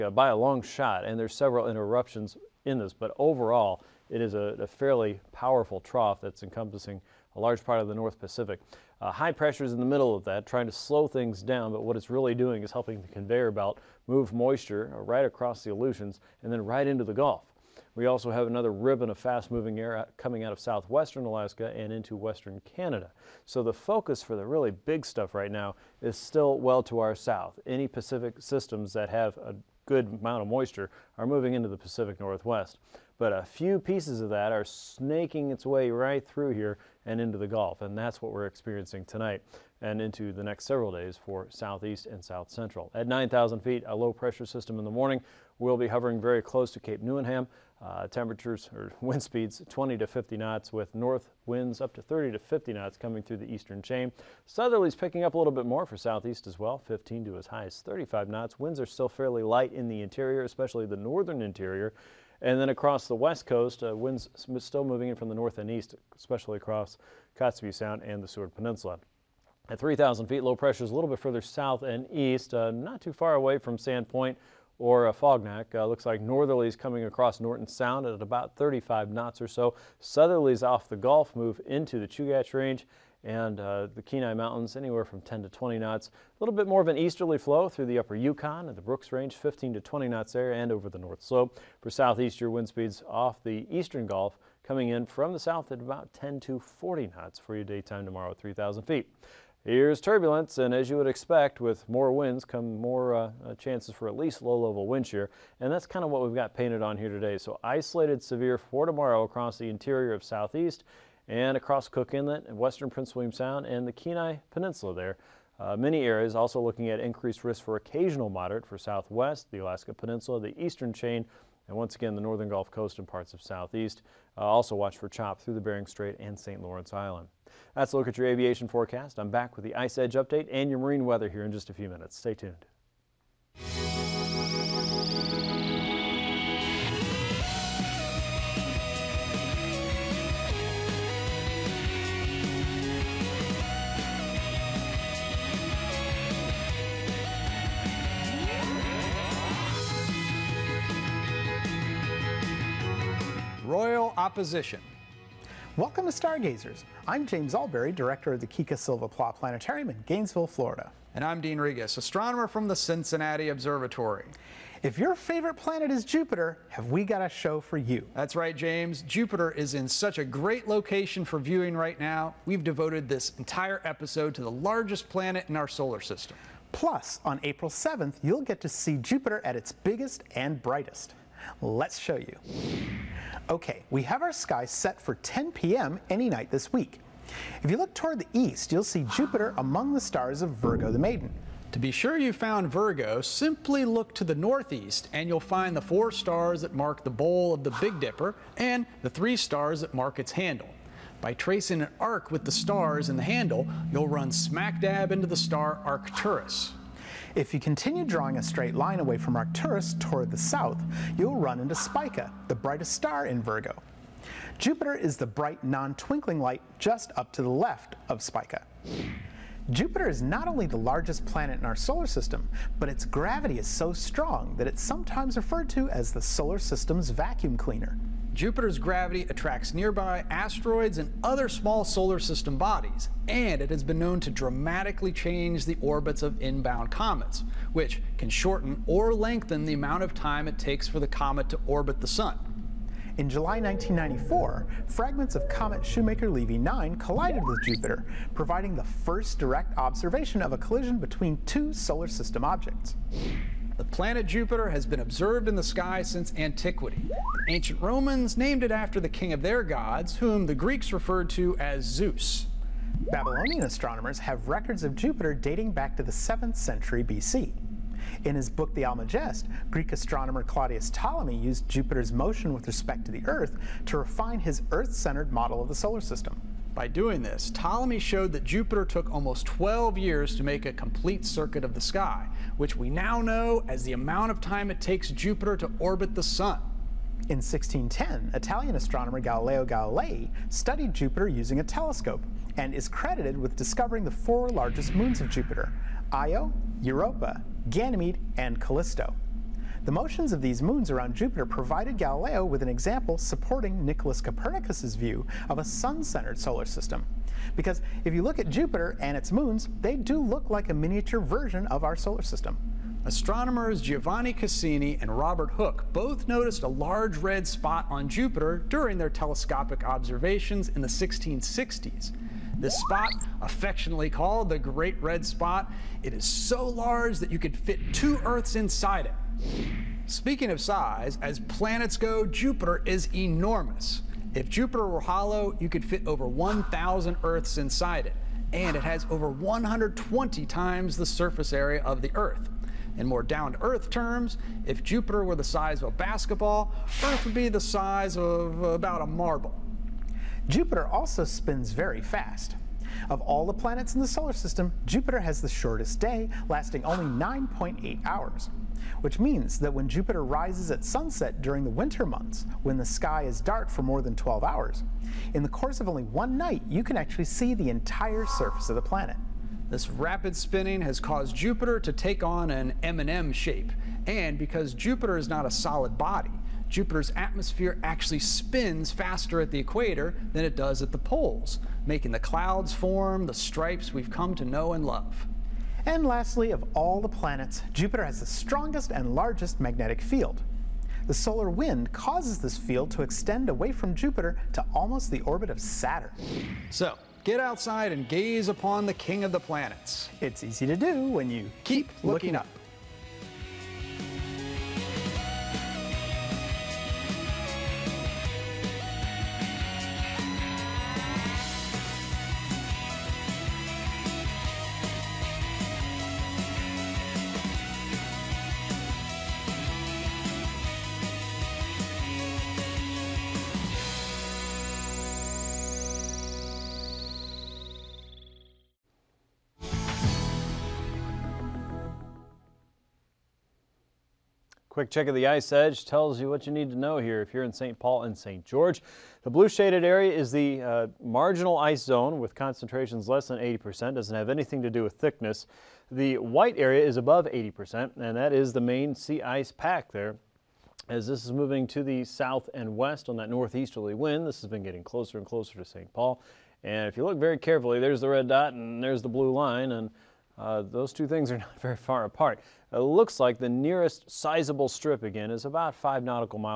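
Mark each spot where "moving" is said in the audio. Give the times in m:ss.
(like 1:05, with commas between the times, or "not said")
0:19, 0:31, 1:04, 7:31.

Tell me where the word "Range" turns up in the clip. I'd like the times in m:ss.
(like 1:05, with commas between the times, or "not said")
1:22, 1:29.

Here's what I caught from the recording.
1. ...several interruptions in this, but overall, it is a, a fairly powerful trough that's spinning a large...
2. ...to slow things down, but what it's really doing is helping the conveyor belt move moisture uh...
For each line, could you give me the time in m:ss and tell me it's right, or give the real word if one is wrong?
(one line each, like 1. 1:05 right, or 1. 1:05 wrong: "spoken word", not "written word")
1. 0:01 wrong: "encompassing", not "spinning"
2. 0:10 right.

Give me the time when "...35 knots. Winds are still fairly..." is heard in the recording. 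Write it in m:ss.
0:57.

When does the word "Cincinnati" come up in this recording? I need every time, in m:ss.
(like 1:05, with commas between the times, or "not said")
2:42.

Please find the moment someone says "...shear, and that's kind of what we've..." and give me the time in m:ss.
1:45.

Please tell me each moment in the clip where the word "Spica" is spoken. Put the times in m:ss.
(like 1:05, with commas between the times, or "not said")
3:31, 3:38.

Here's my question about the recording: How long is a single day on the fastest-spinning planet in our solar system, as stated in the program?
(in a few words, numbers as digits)
9.8 hours.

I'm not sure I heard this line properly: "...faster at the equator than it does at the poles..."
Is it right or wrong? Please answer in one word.
right.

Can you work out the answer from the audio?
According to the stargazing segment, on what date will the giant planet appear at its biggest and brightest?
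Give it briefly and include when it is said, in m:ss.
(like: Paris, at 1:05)
April 7th, at 2:57.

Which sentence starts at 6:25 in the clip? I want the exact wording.
And lastly, of all the planets, Jupiter has the strongest and largest magnetic field.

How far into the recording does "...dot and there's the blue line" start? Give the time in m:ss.
7:38.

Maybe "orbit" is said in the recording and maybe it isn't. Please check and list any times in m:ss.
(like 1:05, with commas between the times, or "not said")
3:55, 4:01, 4:45, 6:35.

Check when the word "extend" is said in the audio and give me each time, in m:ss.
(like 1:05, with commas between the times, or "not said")
6:33.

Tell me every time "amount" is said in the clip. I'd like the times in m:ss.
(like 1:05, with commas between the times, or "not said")
0:30, 3:59, 4:43.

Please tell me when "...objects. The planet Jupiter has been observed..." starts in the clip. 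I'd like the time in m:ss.
4:12.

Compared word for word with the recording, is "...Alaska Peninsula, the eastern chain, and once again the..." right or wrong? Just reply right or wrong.
right.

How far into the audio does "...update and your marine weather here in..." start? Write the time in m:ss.
2:10.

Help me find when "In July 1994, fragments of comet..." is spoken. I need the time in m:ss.
4:03.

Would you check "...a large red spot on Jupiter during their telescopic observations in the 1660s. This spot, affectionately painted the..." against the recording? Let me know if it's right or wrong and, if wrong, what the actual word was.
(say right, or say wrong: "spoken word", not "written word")
wrong: "called", not "painted".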